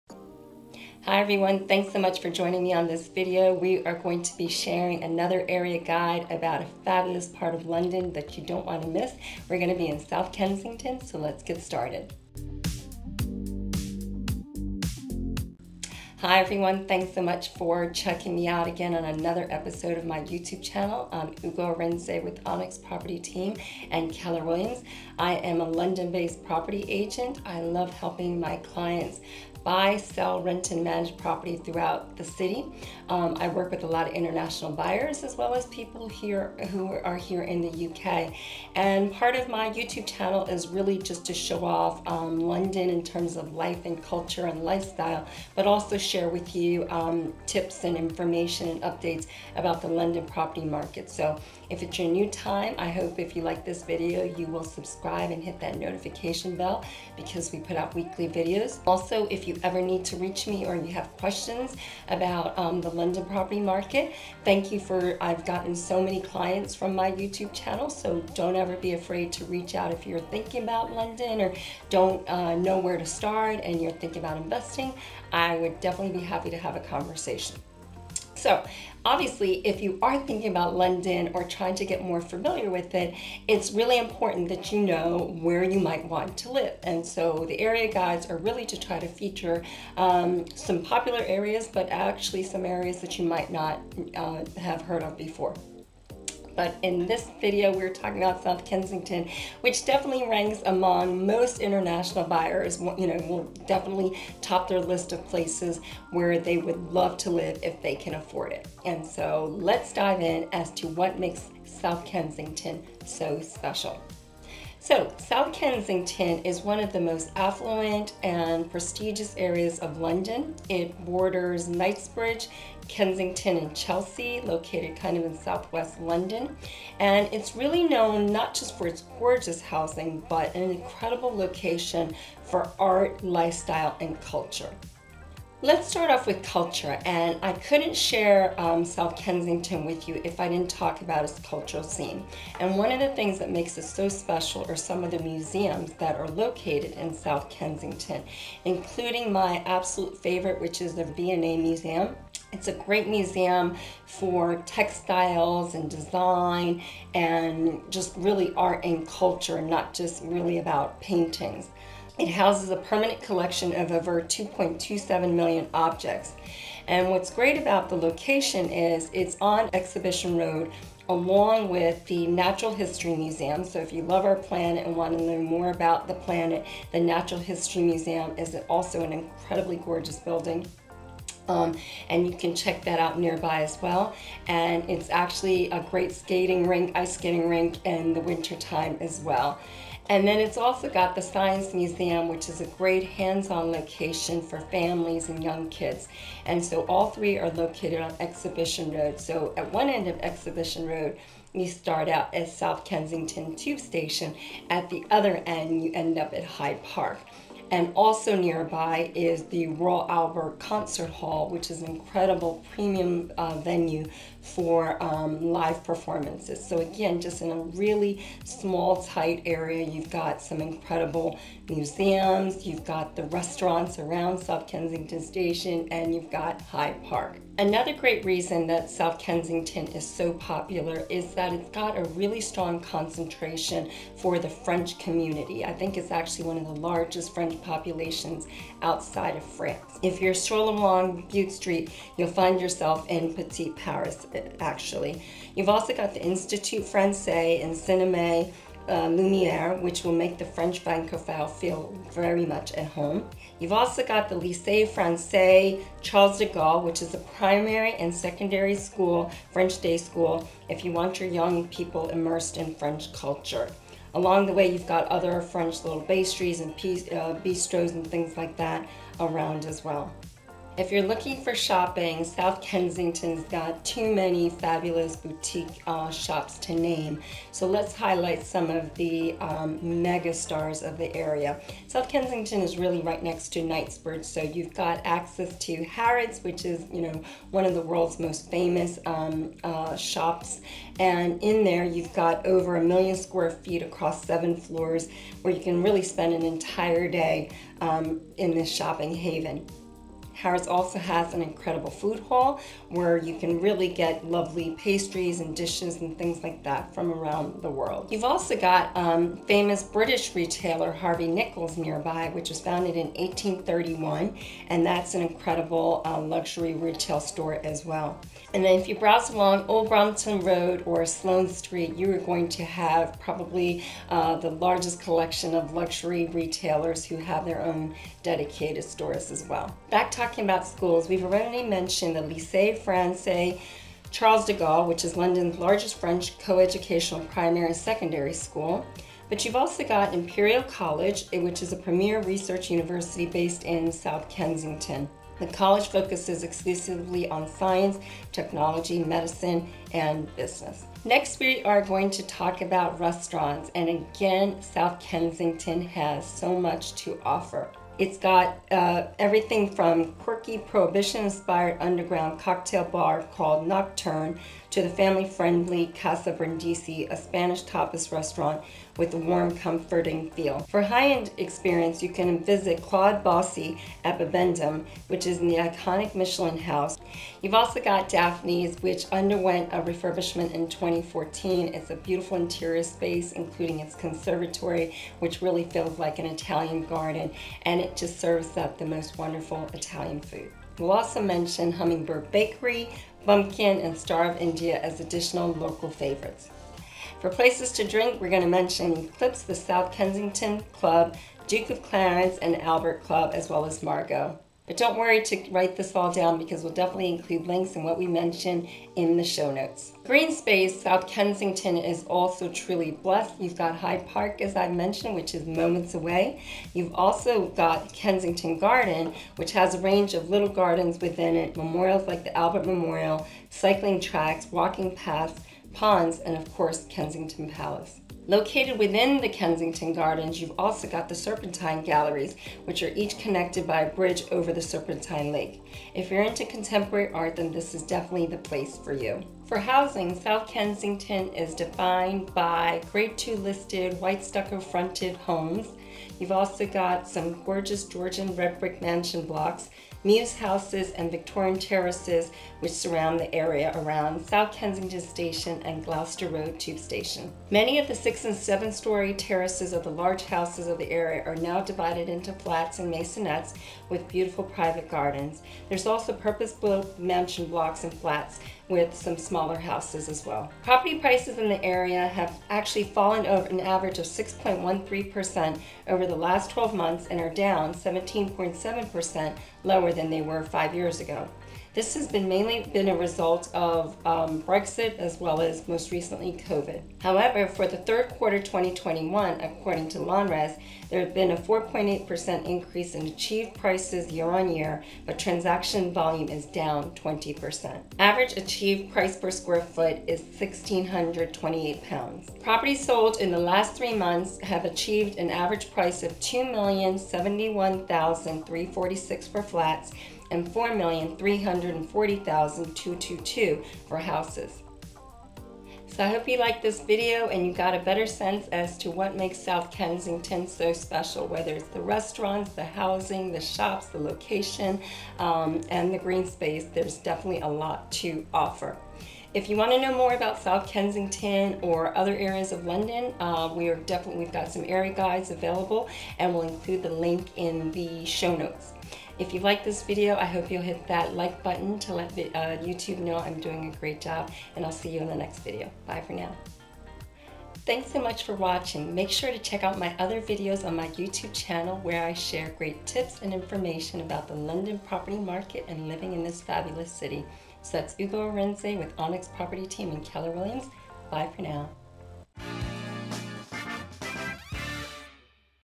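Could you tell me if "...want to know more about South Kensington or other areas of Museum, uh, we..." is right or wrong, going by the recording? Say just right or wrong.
wrong.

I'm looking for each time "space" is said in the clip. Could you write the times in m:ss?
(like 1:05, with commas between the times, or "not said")
6:22, 6:50, 8:46.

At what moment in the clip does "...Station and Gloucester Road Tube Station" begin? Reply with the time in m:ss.
7:34.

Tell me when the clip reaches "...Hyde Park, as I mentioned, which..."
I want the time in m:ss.
6:53.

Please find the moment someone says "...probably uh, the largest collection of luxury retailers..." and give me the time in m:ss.
5:23.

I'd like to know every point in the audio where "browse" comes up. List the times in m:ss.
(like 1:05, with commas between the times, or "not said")
5:18.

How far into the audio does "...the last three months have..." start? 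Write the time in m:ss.
8:23.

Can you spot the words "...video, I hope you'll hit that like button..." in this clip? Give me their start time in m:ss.
8:59.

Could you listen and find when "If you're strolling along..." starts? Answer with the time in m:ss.
4:00.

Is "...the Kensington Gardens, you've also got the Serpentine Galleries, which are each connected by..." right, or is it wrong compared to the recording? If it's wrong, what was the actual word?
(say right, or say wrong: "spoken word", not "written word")
right.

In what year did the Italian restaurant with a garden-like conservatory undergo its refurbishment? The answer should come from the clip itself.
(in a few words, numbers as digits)
2014.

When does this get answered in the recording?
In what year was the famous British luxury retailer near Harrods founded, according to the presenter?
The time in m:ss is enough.
5:13.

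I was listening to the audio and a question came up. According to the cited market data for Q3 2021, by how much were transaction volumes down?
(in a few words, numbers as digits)
20%.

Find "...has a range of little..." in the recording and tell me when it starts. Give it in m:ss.
6:59.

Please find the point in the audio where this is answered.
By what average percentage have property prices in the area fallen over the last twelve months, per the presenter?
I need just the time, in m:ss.
7:54.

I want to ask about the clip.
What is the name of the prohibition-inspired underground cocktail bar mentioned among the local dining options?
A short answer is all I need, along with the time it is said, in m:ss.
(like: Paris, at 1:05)
Nocturne, at 6:03.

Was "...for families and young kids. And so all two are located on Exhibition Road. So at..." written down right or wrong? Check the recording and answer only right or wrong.
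wrong.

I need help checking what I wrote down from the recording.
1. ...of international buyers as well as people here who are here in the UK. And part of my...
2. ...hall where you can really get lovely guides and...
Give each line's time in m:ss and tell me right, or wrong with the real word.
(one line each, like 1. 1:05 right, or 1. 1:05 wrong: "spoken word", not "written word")
1. 0:34 right
2. 5:02 wrong: "pastries", not "guides".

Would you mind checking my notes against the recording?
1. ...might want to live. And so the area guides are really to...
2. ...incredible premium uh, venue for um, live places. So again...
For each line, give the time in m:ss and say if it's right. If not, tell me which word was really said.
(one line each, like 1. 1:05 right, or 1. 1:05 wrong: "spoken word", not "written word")
1. 1:25 right
2. 3:31 wrong: "performances", not "places".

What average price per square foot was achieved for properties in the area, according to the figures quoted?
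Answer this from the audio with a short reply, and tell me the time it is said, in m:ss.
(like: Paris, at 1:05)
£1,628, at 8:20.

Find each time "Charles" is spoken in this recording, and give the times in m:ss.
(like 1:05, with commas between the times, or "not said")
4:16, 5:34.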